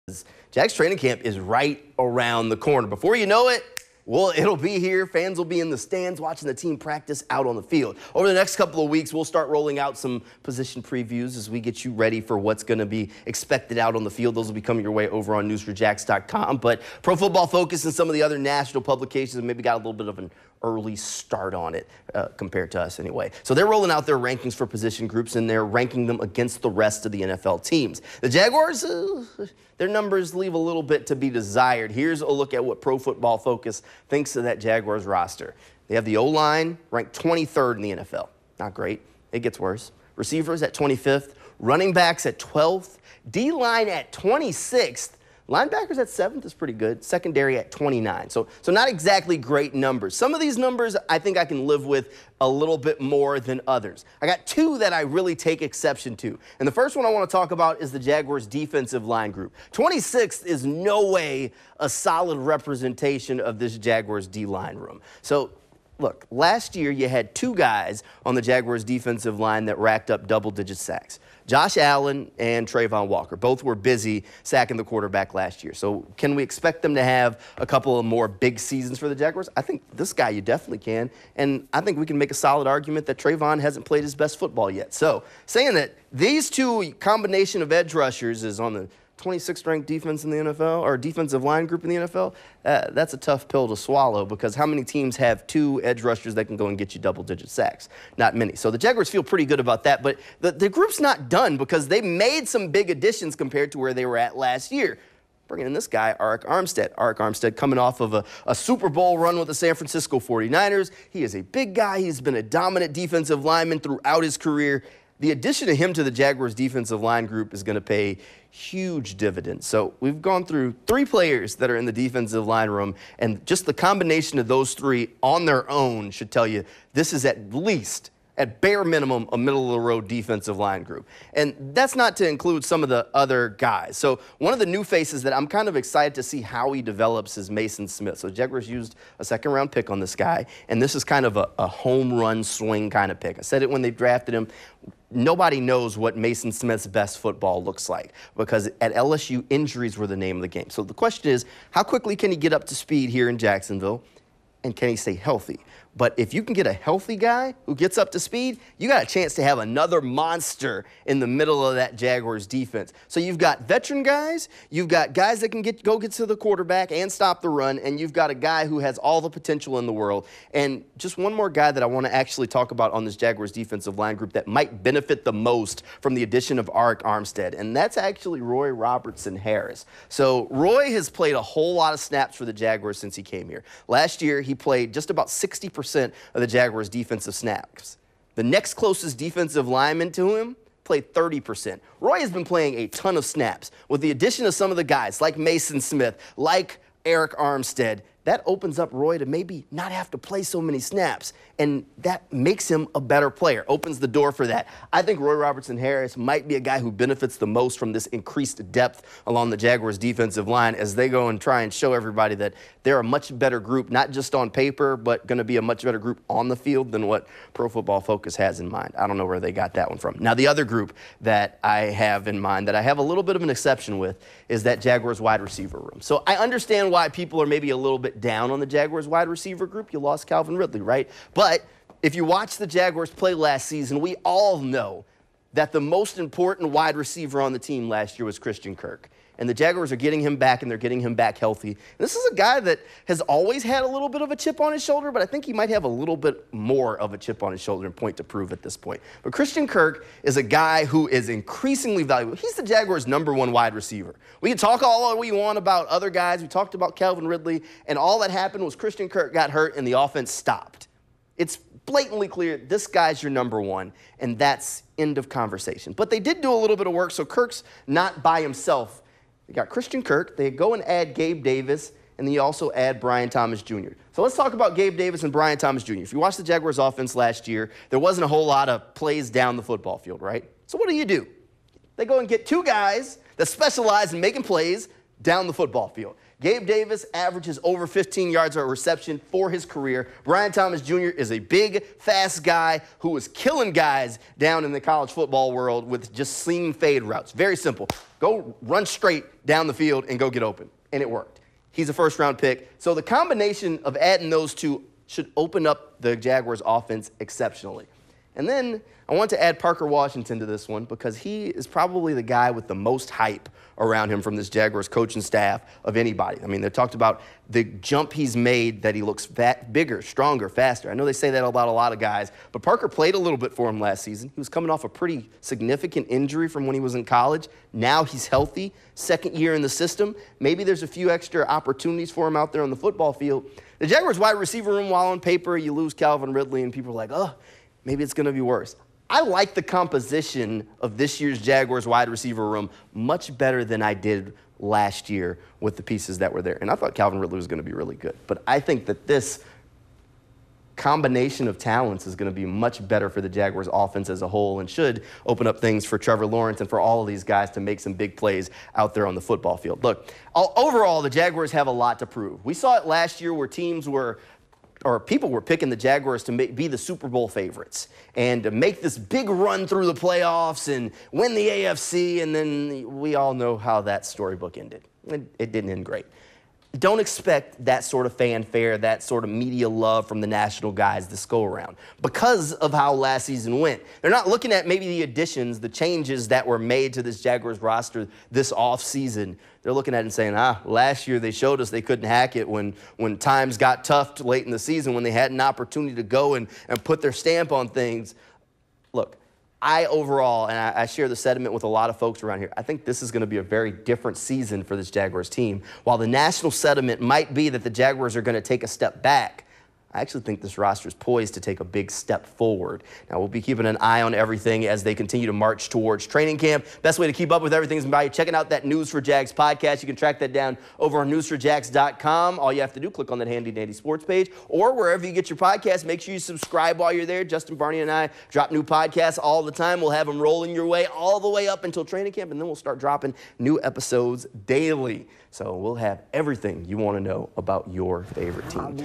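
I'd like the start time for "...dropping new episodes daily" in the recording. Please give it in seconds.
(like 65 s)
432 s.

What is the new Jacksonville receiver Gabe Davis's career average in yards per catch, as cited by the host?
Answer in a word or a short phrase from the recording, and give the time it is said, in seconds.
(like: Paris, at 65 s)
over 15 yards, at 287 s.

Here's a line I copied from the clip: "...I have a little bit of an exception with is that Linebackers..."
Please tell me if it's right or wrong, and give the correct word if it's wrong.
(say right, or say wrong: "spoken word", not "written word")
wrong: "Jaguars", not "Linebackers".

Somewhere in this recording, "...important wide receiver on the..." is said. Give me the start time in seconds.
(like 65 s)
236 s.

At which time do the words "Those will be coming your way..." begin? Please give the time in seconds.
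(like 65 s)
14 s.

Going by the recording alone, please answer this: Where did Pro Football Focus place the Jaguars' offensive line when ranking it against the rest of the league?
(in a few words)
23rd.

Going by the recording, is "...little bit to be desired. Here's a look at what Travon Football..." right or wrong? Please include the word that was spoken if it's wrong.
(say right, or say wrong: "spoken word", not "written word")
wrong: "Pro", not "Travon".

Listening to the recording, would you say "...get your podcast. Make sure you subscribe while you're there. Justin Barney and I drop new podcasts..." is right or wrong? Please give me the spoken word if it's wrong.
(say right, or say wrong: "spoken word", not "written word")
right.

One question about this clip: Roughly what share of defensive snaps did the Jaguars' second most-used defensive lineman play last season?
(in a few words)
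30%.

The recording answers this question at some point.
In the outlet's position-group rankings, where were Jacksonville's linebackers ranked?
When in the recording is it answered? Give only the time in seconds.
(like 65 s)
46 s.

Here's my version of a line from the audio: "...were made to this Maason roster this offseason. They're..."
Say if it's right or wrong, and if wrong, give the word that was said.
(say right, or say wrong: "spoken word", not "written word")
wrong: "Jaguars", not "Maason".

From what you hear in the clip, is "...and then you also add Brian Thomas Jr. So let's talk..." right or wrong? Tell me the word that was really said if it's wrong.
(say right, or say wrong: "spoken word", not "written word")
right.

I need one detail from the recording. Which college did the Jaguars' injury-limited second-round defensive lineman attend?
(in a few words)
LSU.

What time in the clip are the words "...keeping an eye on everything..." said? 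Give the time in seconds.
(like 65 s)
413 s.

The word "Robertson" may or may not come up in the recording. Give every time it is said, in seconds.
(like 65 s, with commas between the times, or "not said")
178 s, 205 s.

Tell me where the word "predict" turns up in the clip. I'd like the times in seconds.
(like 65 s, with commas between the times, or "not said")
not said.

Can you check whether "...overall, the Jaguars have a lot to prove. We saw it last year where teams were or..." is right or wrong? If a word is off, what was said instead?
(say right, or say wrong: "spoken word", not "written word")
right.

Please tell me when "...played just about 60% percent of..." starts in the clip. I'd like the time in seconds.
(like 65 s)
184 s.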